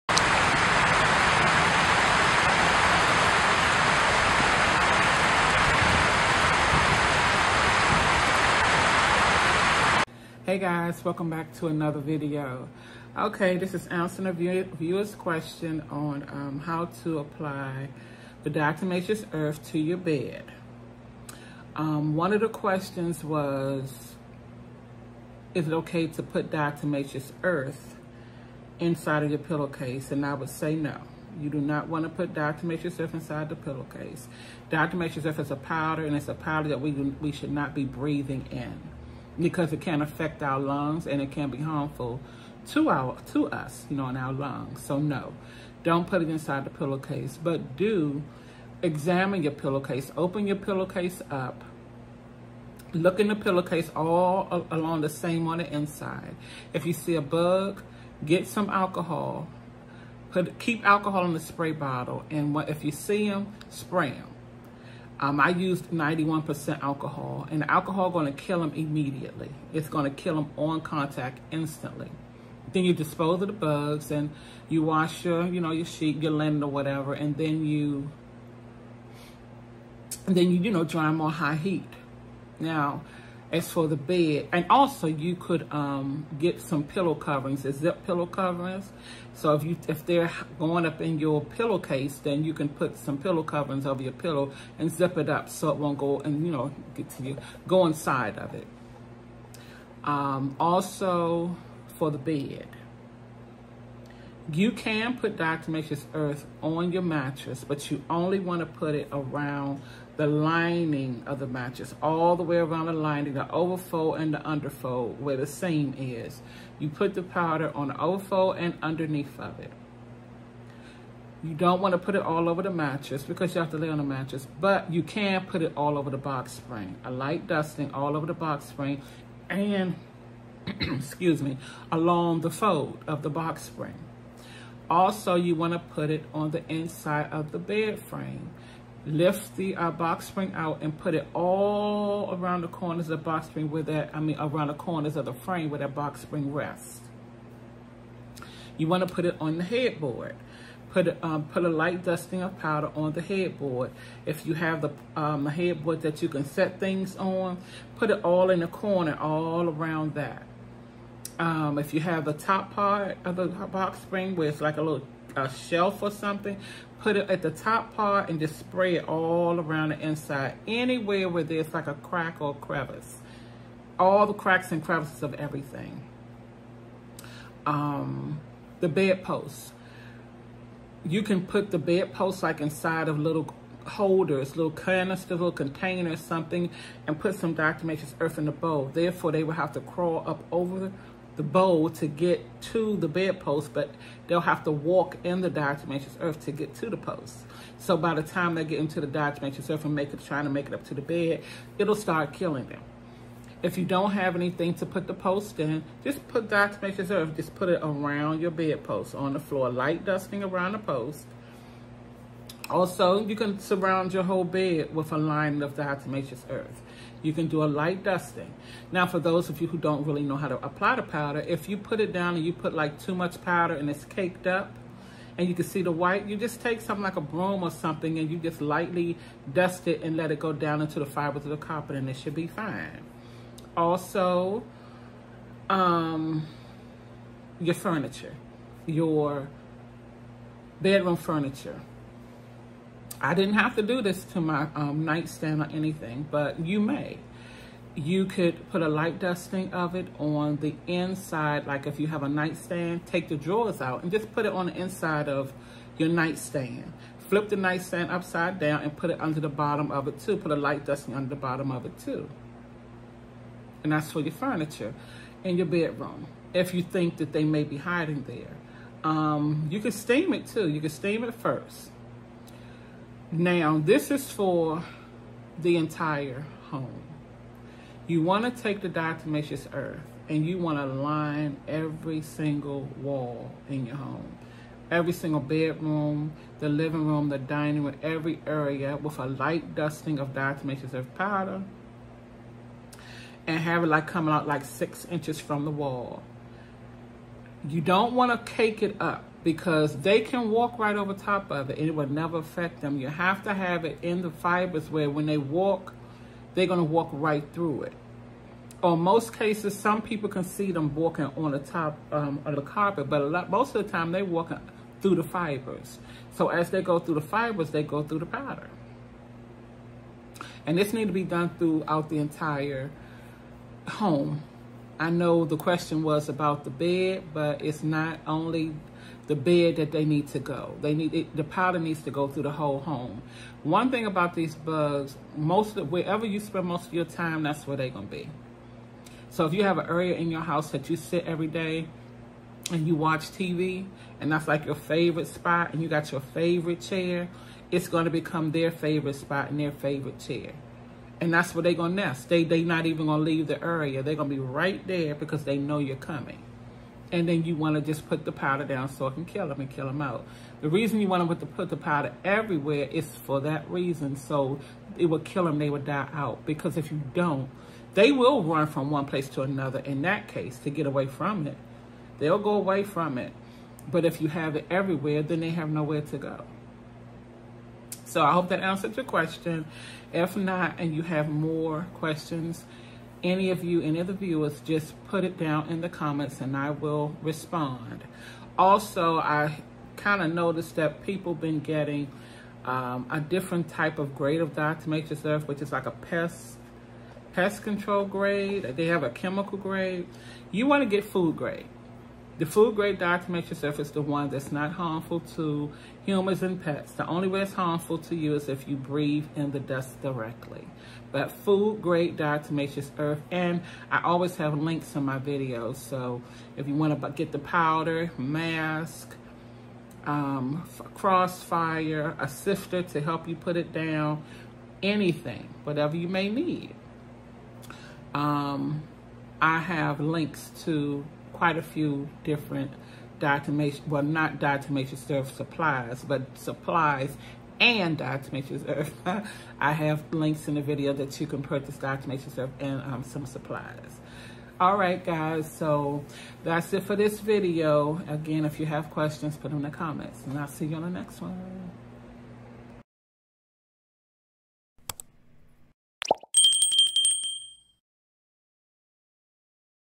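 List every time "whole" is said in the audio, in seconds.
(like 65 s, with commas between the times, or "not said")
214 s, 332 s.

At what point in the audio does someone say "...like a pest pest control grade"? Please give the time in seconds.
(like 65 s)
395 s.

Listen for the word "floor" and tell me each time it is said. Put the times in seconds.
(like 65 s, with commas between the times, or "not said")
209 s.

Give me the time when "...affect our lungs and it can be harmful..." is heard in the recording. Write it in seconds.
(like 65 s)
40 s.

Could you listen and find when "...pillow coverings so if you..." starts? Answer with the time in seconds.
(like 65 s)
88 s.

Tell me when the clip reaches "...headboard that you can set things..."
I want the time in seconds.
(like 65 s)
155 s.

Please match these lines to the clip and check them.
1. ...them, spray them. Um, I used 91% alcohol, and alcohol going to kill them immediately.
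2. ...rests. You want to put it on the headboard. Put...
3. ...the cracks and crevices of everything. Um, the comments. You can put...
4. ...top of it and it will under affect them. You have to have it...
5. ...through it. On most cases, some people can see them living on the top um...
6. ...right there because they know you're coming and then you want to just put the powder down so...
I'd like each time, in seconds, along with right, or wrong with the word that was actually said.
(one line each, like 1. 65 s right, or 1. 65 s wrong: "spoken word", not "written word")
1. 63 s right
2. 146 s right
3. 174 s wrong: "bedposts", not "comments"
4. 301 s wrong: "never", not "under"
5. 307 s wrong: "walking", not "living"
6. 354 s right.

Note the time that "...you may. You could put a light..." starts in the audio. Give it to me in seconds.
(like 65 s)
246 s.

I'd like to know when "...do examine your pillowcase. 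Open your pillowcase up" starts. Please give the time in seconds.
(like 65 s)
47 s.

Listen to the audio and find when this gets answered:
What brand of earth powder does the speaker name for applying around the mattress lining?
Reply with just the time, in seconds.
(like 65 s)
105 s.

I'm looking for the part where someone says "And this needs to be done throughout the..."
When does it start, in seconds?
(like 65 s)
320 s.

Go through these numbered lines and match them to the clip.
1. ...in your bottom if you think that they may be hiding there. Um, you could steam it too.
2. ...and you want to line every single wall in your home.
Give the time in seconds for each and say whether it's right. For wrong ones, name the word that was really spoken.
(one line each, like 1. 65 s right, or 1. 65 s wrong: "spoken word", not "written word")
1. 265 s wrong: "bedroom", not "bottom"
2. 280 s right.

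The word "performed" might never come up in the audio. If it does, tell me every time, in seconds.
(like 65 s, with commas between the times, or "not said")
not said.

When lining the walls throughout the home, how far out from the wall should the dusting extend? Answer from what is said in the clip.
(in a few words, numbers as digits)
6 inches.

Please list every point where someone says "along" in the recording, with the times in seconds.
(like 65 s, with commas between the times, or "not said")
54 s, 131 s.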